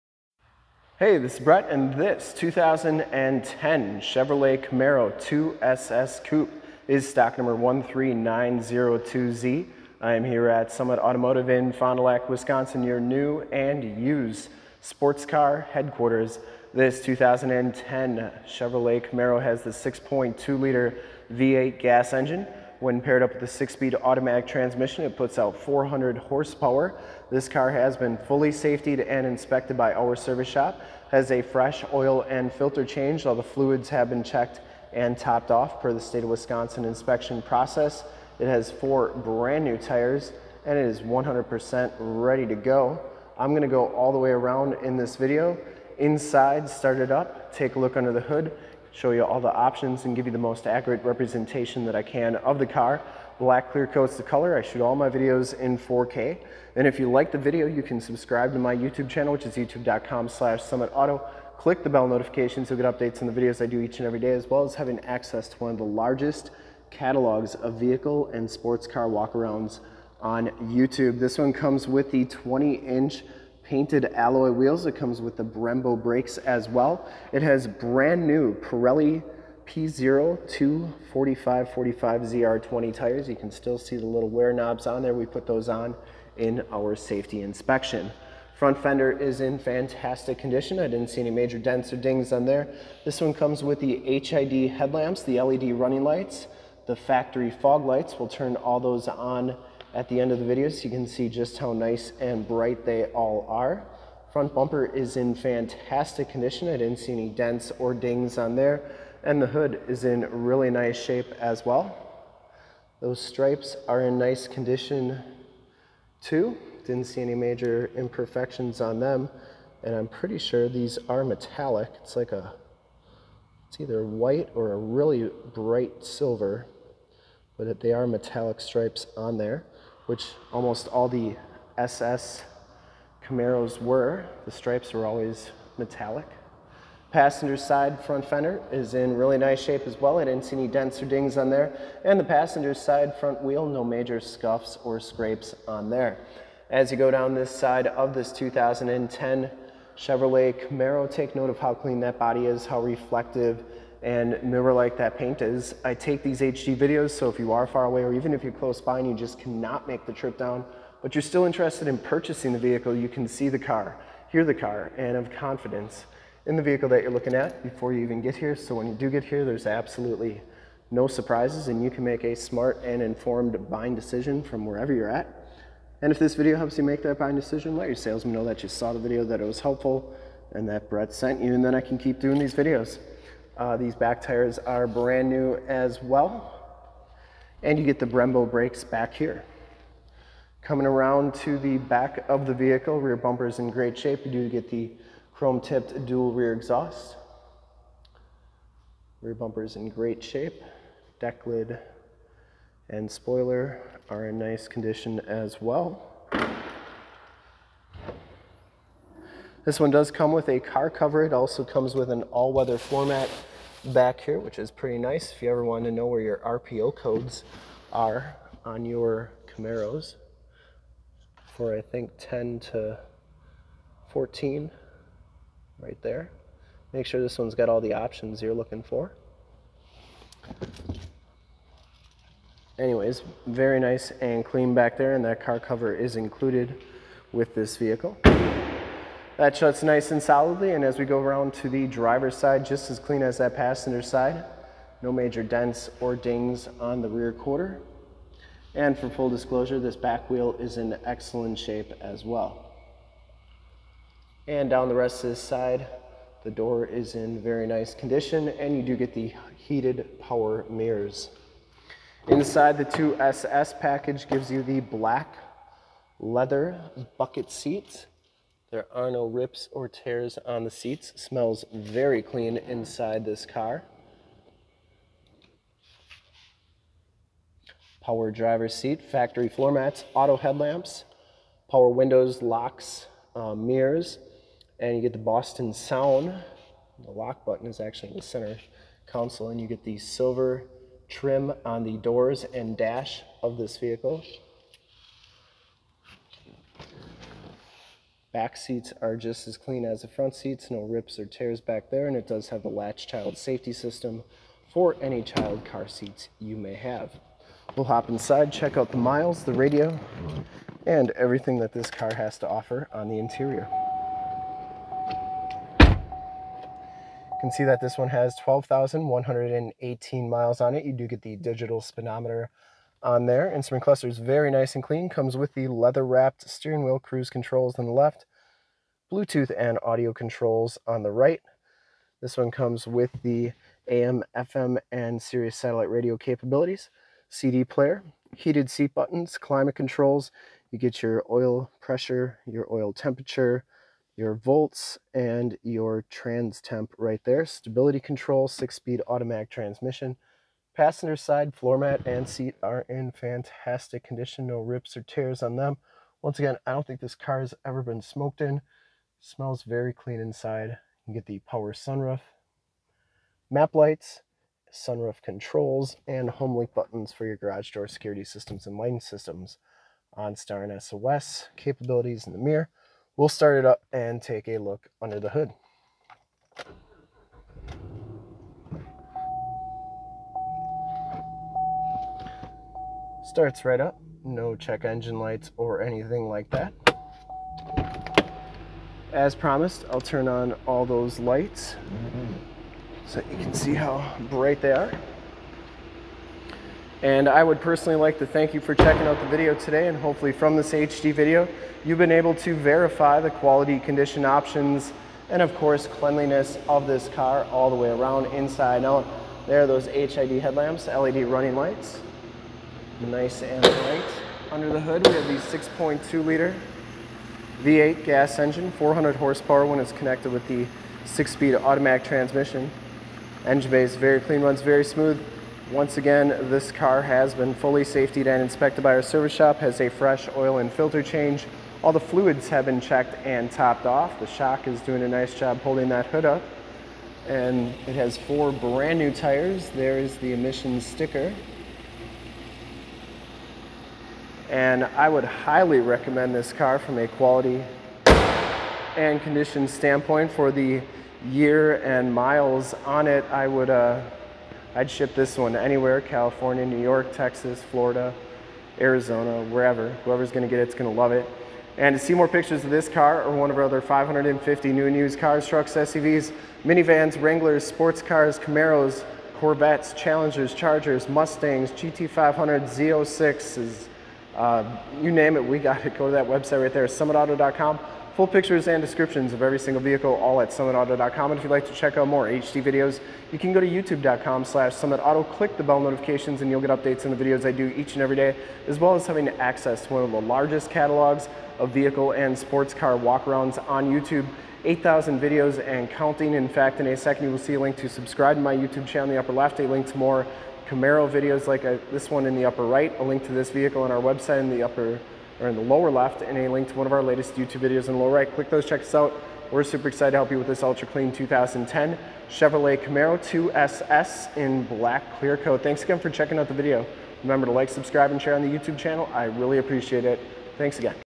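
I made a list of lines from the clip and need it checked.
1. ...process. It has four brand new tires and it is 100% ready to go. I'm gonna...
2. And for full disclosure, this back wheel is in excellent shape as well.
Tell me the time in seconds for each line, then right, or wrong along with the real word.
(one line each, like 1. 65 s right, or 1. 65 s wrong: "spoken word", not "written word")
1. 37 s right
2. 248 s right.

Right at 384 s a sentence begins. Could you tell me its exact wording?
No check engine lights or anything like that.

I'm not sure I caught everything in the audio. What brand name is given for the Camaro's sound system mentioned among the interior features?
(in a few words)
Boston Sound.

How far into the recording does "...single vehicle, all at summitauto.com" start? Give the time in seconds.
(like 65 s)
479 s.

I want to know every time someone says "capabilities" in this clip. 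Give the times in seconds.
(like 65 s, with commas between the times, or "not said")
336 s, 371 s.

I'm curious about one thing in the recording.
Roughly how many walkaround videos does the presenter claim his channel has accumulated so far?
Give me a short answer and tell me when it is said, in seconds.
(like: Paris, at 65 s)
8,000, at 494 s.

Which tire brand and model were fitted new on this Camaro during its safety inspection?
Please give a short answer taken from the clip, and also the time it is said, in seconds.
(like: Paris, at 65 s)
Pirelli P Zero, at 78 s.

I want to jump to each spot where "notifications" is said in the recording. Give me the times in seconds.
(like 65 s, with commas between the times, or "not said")
62 s, 485 s.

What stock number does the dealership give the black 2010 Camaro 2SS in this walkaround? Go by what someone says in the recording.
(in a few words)
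13902Z.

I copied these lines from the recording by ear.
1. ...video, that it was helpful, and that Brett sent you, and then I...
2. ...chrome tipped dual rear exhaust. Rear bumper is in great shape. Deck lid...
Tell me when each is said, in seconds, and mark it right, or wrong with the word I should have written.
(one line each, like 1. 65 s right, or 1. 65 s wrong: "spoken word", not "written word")
1. 178 s right
2. 195 s right.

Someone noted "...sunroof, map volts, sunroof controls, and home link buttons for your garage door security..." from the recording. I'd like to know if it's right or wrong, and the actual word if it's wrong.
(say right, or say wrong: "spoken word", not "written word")
wrong: "lights", not "volts".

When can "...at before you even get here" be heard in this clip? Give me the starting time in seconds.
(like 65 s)
167 s.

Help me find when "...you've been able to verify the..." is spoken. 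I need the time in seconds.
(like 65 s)
401 s.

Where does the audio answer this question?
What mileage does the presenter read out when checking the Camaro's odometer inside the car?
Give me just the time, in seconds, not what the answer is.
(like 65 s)
318 s.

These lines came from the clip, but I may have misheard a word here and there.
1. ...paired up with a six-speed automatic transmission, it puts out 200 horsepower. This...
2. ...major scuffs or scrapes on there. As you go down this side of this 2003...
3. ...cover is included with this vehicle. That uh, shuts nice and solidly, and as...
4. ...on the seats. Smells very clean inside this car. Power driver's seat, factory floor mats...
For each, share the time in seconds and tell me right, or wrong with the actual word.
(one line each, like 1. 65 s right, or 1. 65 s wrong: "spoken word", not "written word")
1. 22 s wrong: "400", not "200"
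2. 143 s wrong: "2010", not "2003"
3. 235 s right
4. 270 s right.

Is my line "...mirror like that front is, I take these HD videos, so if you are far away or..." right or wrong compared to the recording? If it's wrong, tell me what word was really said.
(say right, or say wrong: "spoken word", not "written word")
wrong: "paint", not "front".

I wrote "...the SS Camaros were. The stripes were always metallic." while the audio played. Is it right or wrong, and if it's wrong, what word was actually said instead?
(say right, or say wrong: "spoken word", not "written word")
right.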